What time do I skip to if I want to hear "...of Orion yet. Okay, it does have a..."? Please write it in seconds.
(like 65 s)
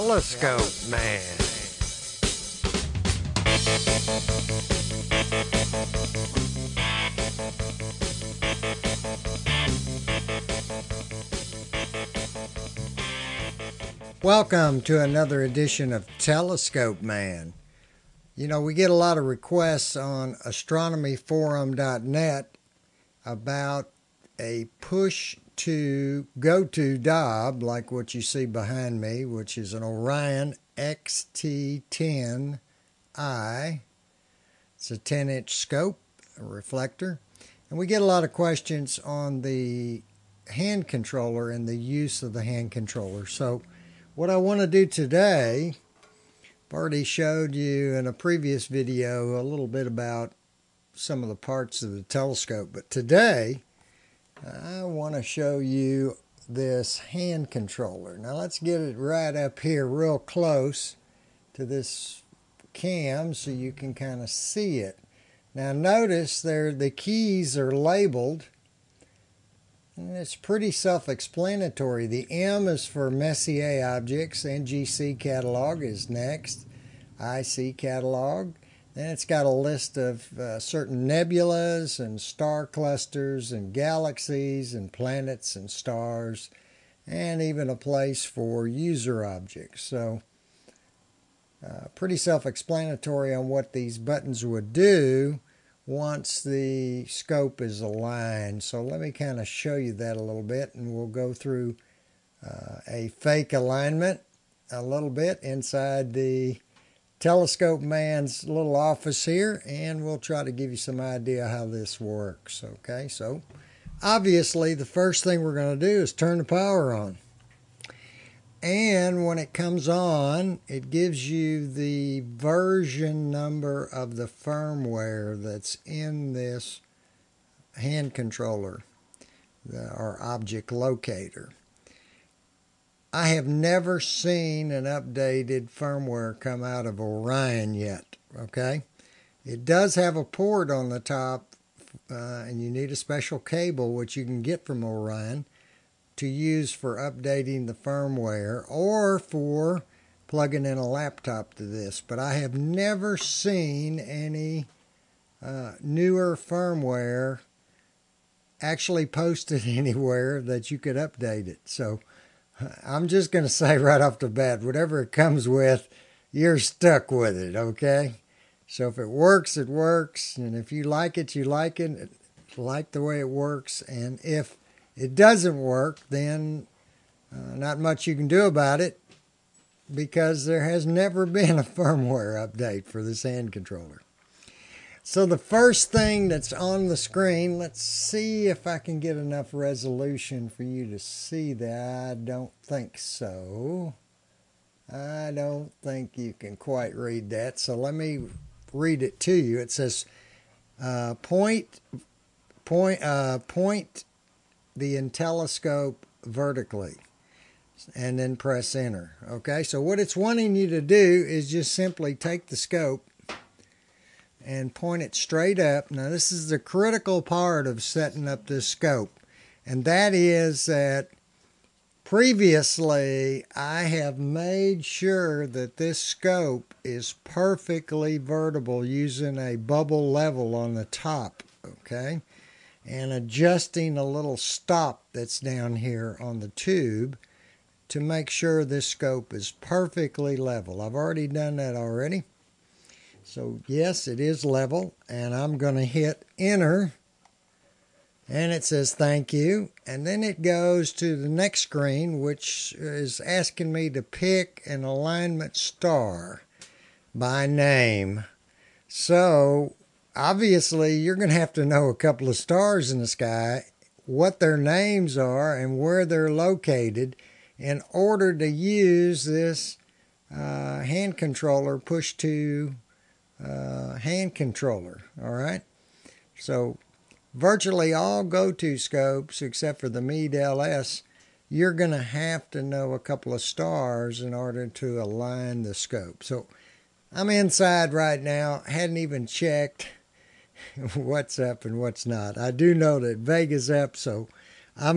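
136 s.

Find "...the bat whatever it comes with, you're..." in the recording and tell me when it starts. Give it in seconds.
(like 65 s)
164 s.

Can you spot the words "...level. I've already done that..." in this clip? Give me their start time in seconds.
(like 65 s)
240 s.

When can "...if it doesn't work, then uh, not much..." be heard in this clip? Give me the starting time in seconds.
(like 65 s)
174 s.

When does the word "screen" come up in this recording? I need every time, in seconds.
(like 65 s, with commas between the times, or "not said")
186 s, 251 s.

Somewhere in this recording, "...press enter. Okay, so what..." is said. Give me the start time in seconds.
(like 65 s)
208 s.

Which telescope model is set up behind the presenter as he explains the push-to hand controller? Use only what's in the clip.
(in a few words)
Orion XT10i.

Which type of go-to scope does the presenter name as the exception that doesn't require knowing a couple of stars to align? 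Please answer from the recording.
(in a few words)
Meade LS.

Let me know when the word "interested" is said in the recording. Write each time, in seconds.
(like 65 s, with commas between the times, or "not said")
not said.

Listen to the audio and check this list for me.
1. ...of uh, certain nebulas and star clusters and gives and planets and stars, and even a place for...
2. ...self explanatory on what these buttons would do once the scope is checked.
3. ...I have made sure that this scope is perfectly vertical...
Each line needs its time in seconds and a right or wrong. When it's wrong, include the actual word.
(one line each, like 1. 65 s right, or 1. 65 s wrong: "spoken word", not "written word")
1. 79 s wrong: "galaxies", not "gives"
2. 92 s wrong: "aligned", not "checked"
3. 223 s right.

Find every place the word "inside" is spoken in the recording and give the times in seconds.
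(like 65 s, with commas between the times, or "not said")
105 s, 287 s.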